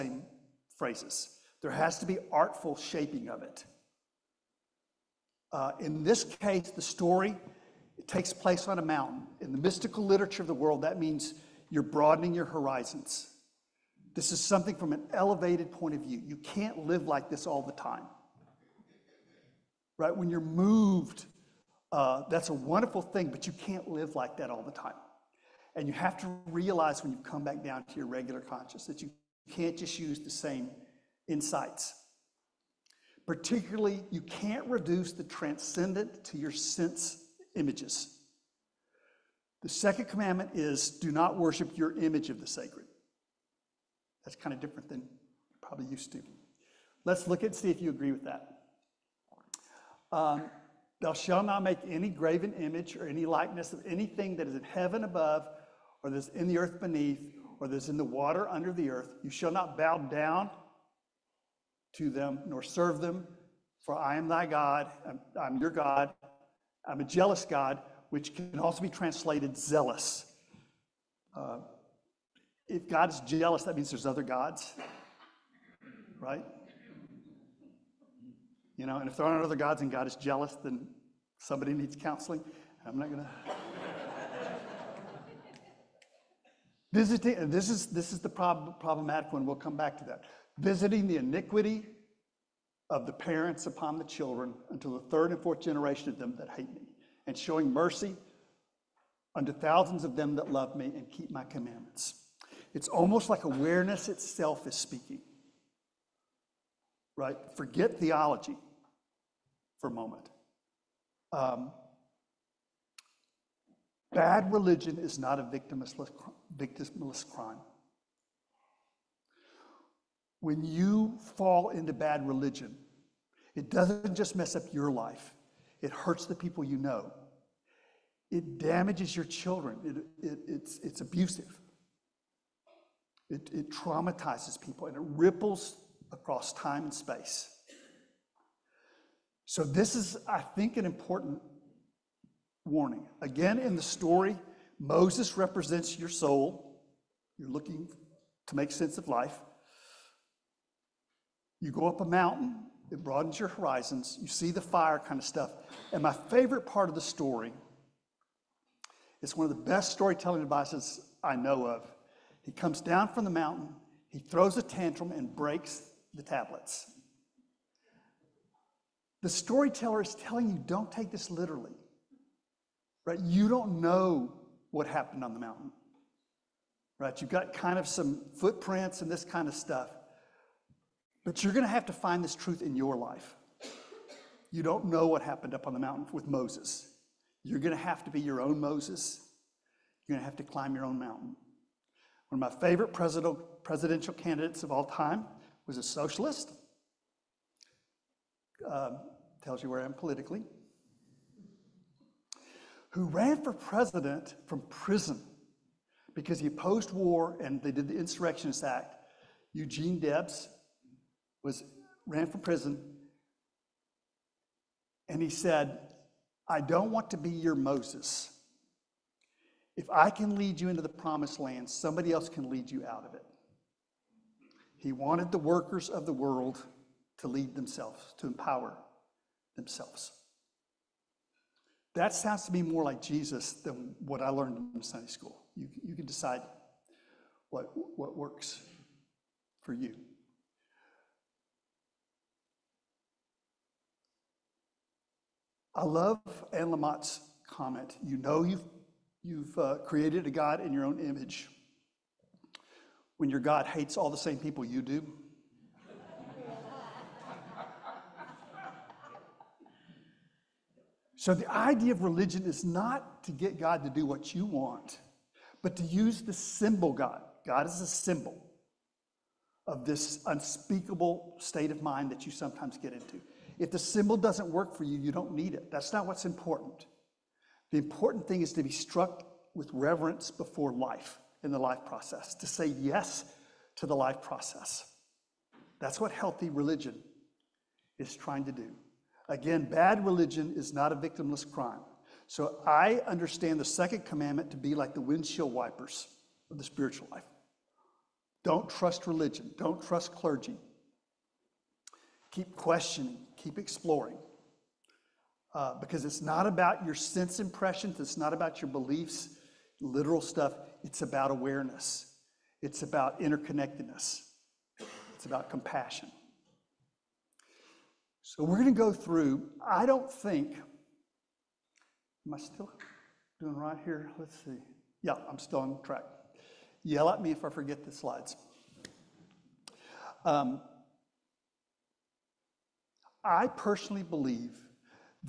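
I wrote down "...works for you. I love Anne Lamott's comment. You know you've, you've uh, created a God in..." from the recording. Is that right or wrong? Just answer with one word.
right.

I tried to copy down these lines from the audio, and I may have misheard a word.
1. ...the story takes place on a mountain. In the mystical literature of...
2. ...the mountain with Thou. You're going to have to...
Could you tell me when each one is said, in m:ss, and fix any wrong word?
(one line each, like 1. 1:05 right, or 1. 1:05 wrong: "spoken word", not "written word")
1. 0:06 right
2. 3:05 wrong: "Moses", not "Thou".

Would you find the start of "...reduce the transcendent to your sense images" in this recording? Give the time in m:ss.
0:34.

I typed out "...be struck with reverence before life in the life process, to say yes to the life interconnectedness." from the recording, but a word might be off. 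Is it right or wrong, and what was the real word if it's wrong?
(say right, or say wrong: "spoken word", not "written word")
wrong: "process", not "interconnectedness".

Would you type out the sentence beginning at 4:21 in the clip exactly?
so the idea of religion is not to get God to do what you want, but to use the symbol God.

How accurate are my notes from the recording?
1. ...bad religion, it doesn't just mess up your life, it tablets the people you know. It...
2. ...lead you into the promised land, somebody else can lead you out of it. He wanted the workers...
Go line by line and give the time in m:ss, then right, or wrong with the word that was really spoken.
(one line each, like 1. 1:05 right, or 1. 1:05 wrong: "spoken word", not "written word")
1. 2:01 wrong: "hurts", not "tablets"
2. 3:40 right.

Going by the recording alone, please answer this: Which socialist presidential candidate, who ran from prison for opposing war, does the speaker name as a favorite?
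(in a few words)
Eugene Debs.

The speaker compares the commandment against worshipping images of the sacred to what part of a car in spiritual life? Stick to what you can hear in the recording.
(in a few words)
Windshield wipers.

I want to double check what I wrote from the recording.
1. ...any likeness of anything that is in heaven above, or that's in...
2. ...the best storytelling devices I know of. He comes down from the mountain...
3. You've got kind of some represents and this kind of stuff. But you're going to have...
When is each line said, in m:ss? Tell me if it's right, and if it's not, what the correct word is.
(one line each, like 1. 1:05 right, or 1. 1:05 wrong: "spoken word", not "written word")
1. 0:53 right
2. 2:39 right
3. 2:57 wrong: "footprints", not "represents".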